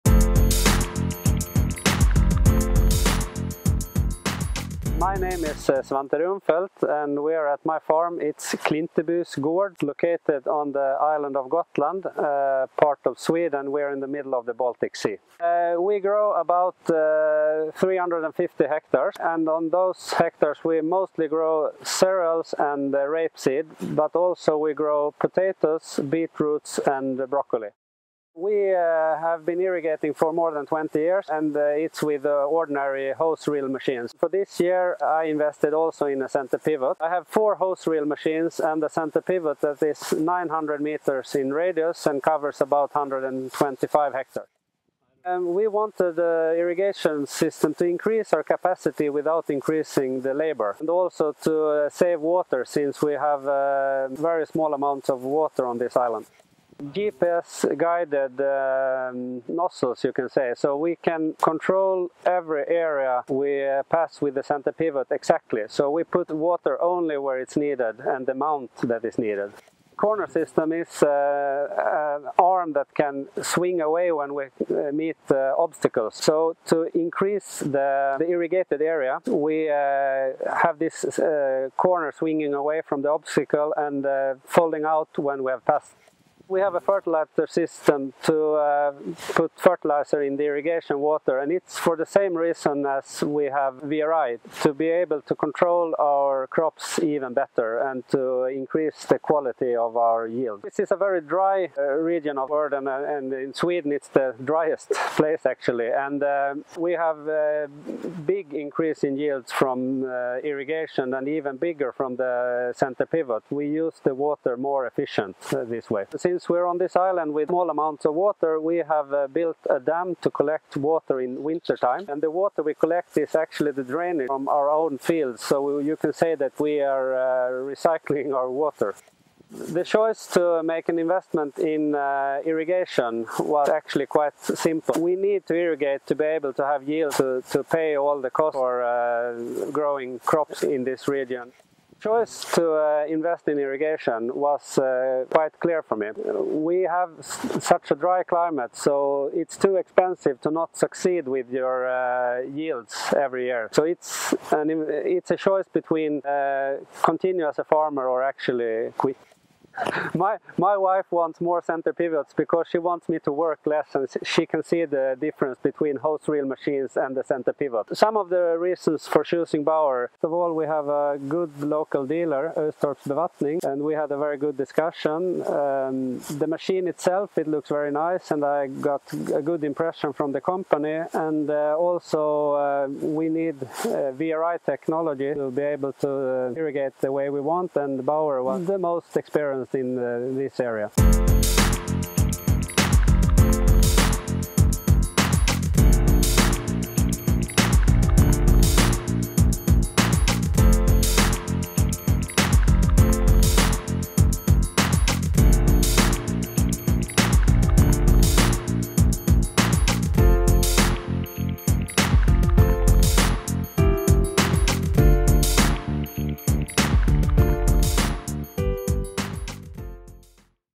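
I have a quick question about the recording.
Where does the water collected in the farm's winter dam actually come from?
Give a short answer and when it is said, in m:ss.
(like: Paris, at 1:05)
drainage from our own fields, at 2:03.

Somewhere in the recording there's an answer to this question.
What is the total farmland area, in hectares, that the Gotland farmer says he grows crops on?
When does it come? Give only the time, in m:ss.
0:17.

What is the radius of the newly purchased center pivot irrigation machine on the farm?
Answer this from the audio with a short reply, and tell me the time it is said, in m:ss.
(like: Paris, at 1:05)
900 meters, at 0:40.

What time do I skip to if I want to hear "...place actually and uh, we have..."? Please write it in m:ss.
1:45.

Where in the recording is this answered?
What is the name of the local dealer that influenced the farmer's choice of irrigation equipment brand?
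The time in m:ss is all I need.
2:52.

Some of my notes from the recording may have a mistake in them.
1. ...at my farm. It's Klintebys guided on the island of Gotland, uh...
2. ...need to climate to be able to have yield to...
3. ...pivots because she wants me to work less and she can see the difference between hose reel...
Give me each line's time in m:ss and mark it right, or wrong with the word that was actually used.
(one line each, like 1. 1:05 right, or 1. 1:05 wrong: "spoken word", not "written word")
1. 0:07 wrong: "located", not "guided"
2. 2:15 wrong: "irrigate", not "climate"
3. 2:41 right.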